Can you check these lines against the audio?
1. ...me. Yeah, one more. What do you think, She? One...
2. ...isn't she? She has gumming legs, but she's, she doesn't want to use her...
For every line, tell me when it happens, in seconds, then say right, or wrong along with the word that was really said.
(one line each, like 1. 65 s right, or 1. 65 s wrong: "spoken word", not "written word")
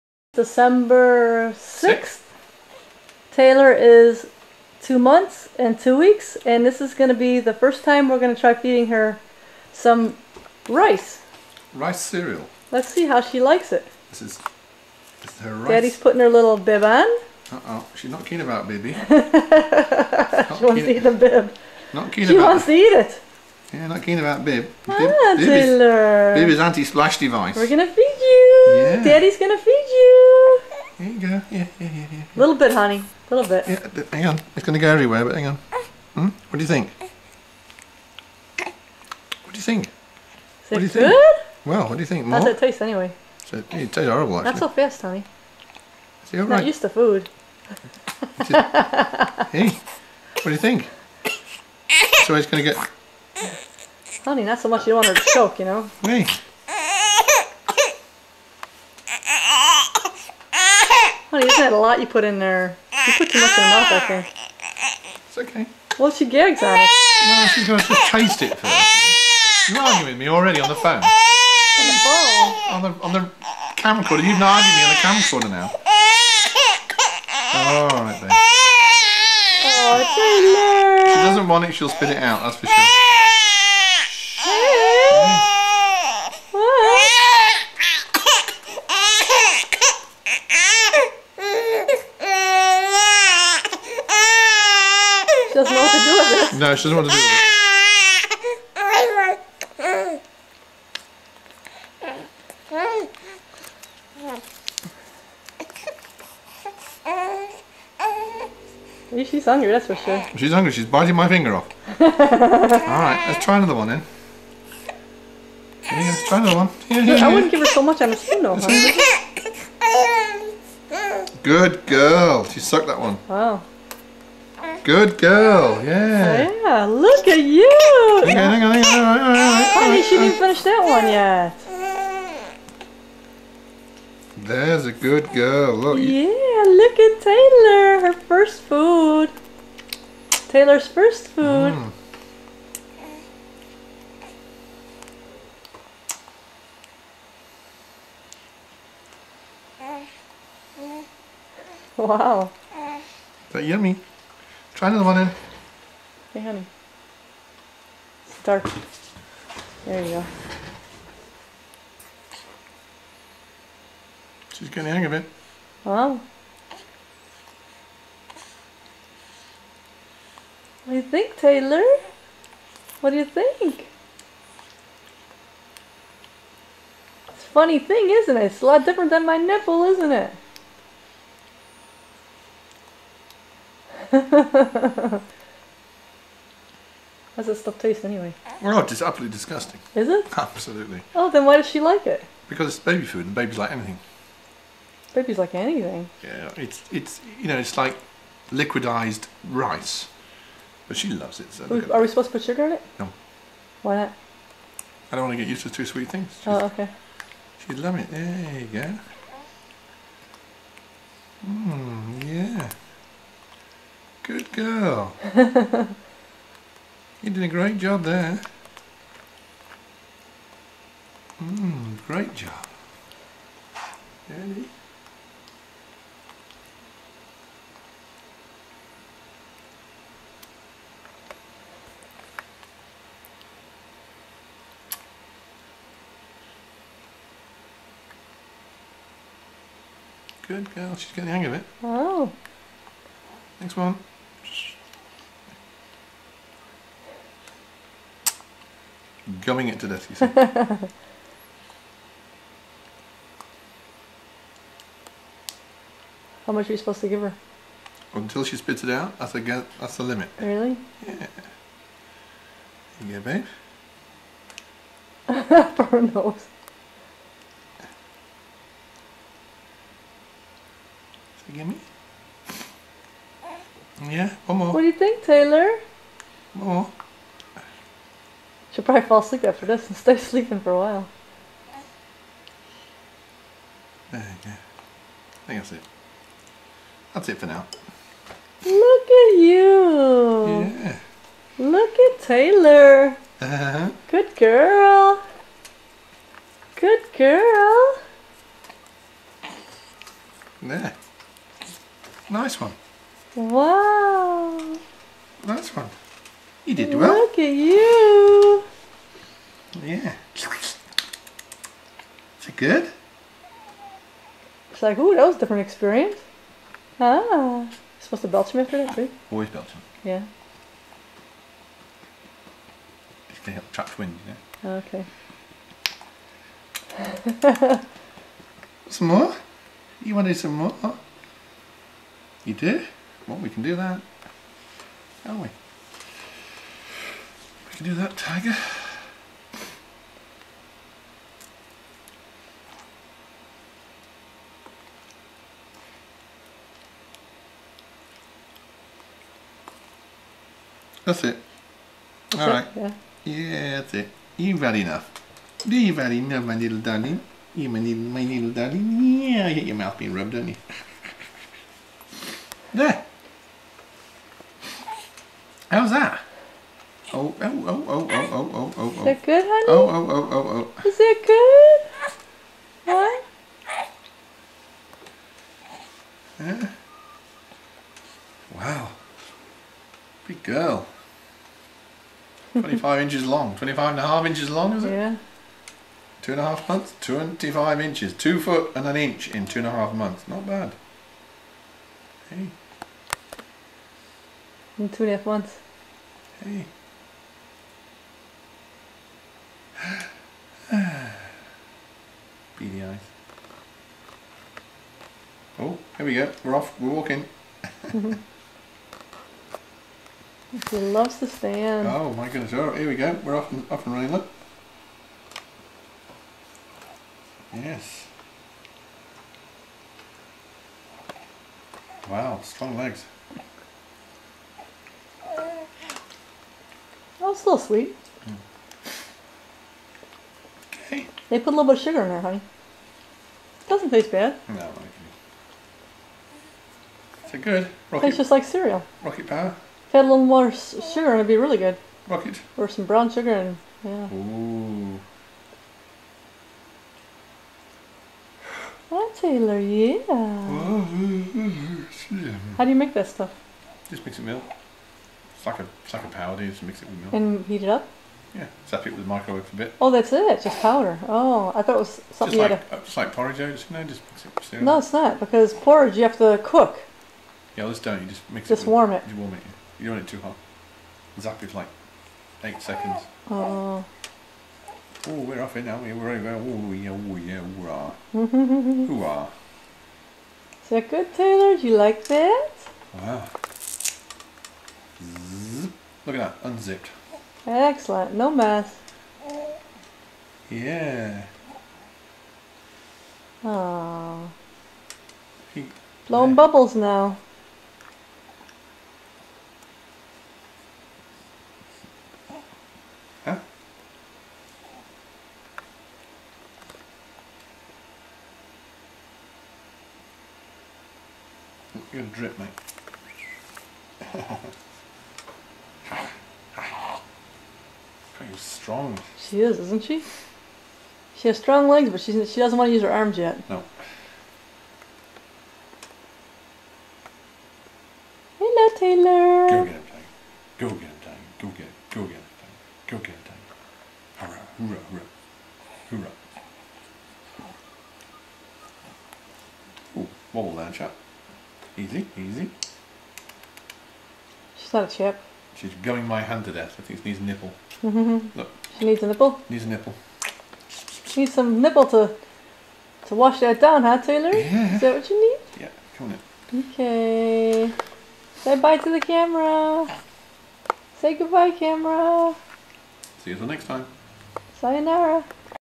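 1. 271 s wrong: "Taylor", not "She"
2. 519 s wrong: "strong", not "gumming".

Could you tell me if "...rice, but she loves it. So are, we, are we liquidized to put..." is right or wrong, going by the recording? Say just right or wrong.
wrong.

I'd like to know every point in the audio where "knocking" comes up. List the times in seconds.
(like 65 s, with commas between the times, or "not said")
not said.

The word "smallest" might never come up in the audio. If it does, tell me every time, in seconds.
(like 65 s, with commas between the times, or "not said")
not said.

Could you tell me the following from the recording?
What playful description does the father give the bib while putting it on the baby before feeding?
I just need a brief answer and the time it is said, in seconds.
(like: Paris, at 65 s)
anti-splash device, at 26 s.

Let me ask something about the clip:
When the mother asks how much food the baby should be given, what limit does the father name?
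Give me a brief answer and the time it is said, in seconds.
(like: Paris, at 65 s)
Until she spits it out, at 258 s.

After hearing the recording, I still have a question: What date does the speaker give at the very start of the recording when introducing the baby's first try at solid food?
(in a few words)
December 6th.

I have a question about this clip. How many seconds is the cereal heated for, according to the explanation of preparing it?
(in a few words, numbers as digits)
8.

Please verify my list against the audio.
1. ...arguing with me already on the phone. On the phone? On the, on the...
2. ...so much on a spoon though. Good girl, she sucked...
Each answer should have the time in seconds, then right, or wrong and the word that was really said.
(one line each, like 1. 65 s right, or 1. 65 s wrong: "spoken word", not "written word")
1. 69 s right
2. 117 s right.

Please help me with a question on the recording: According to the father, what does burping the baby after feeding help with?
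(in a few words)
trap wind.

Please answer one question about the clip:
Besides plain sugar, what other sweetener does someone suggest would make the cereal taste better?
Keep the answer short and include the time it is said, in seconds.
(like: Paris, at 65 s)
brown sugar, at 442 s.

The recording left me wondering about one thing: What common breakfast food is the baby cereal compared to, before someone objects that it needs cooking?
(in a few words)
porridge oats.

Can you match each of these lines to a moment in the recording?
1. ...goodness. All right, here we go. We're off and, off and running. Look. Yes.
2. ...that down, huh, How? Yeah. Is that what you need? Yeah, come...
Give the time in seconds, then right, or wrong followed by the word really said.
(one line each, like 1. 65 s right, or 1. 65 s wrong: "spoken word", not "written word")
1. 412 s right
2. 553 s wrong: "Taylor", not "How".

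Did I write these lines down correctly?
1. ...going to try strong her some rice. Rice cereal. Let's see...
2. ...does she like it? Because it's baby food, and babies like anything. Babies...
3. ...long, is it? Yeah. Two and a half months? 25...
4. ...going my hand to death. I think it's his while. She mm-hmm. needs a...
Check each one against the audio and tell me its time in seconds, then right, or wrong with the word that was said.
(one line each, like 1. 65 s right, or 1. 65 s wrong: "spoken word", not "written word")
1. 8 s wrong: "feeding", not "strong"
2. 191 s right
3. 384 s right
4. 545 s wrong: "nipple", not "while".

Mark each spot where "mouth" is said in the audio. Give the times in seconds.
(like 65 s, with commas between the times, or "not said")
63 s, 359 s.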